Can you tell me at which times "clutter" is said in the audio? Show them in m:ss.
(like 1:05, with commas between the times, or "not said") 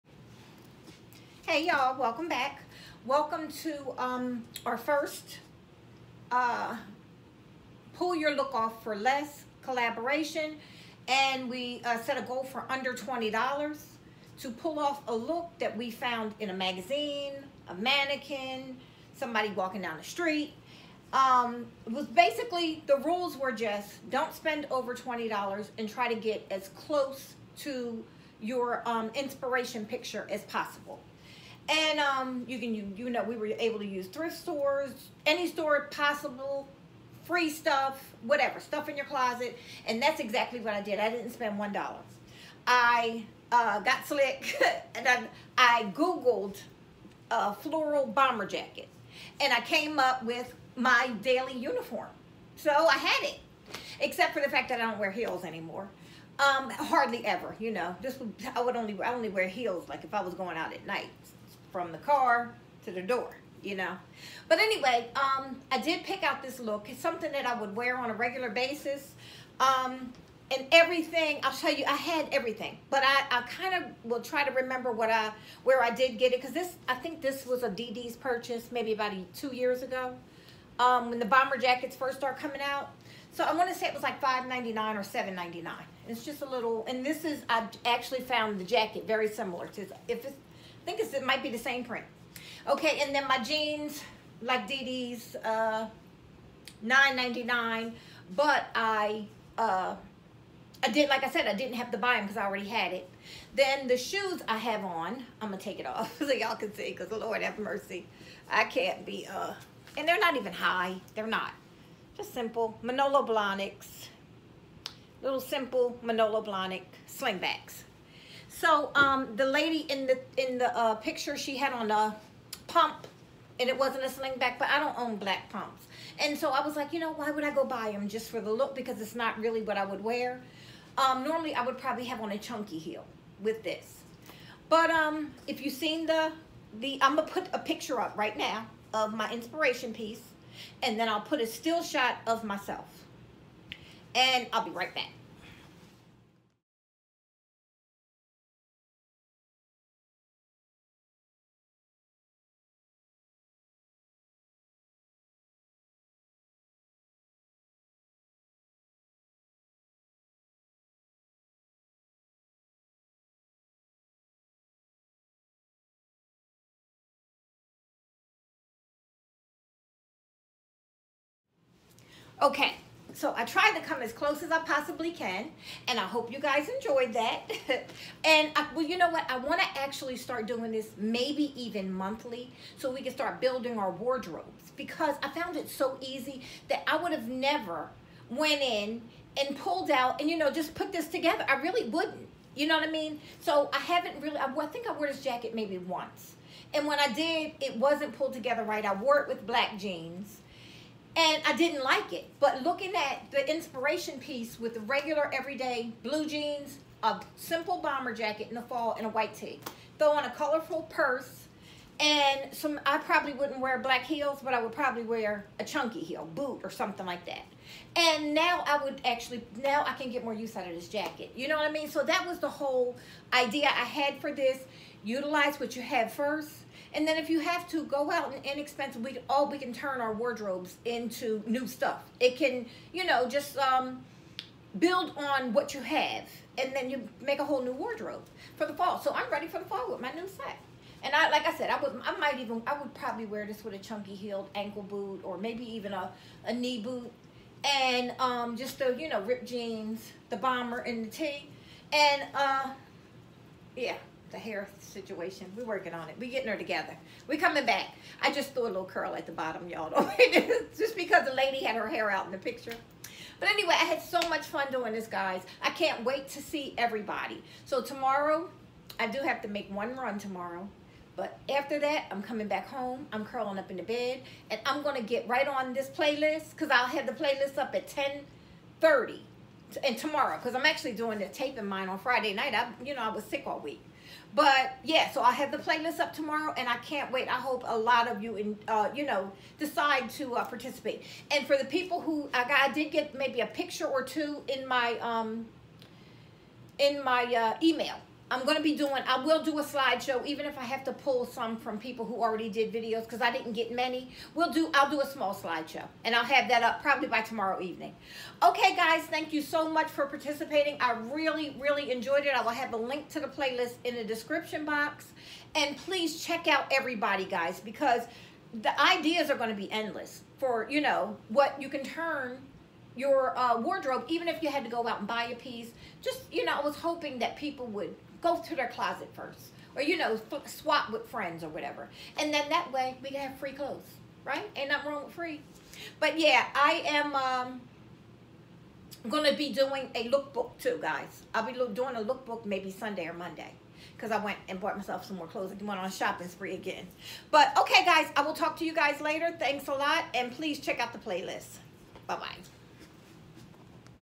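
not said.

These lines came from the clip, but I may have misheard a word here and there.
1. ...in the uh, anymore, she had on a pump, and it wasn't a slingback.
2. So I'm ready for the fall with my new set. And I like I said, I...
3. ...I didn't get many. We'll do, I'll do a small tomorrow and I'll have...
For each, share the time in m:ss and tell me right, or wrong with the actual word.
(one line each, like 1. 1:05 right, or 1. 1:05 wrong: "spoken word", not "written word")
1. 2:00 wrong: "picture", not "anymore"
2. 3:58 right
3. 5:03 wrong: "slideshow", not "tomorrow".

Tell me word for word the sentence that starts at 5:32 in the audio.
And then that way we can have free clothes, right?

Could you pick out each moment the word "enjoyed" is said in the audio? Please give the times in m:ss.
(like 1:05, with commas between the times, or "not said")
2:56, 5:11.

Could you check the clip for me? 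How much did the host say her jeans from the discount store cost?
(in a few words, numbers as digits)
$9.99.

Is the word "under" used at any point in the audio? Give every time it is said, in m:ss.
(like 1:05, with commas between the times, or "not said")
0:12.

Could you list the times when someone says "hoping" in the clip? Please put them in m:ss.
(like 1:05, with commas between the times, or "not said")
5:26.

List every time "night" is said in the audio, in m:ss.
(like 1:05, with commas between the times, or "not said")
1:00, 4:42.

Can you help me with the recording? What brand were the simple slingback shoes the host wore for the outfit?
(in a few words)
Manolo Blahnik.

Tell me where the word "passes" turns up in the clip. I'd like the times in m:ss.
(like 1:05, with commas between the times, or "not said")
not said.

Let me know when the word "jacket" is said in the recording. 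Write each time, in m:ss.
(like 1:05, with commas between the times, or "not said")
0:48, 1:21, 1:28, 3:15, 3:28, 3:40.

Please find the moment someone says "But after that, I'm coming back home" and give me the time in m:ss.
4:31.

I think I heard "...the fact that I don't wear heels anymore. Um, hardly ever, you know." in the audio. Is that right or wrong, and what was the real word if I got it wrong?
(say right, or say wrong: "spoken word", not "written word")
right.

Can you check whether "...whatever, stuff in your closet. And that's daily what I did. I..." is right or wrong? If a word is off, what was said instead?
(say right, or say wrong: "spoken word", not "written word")
wrong: "exactly", not "daily".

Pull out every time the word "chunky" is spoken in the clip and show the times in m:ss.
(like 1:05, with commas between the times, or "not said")
2:12, 3:35, 4:03.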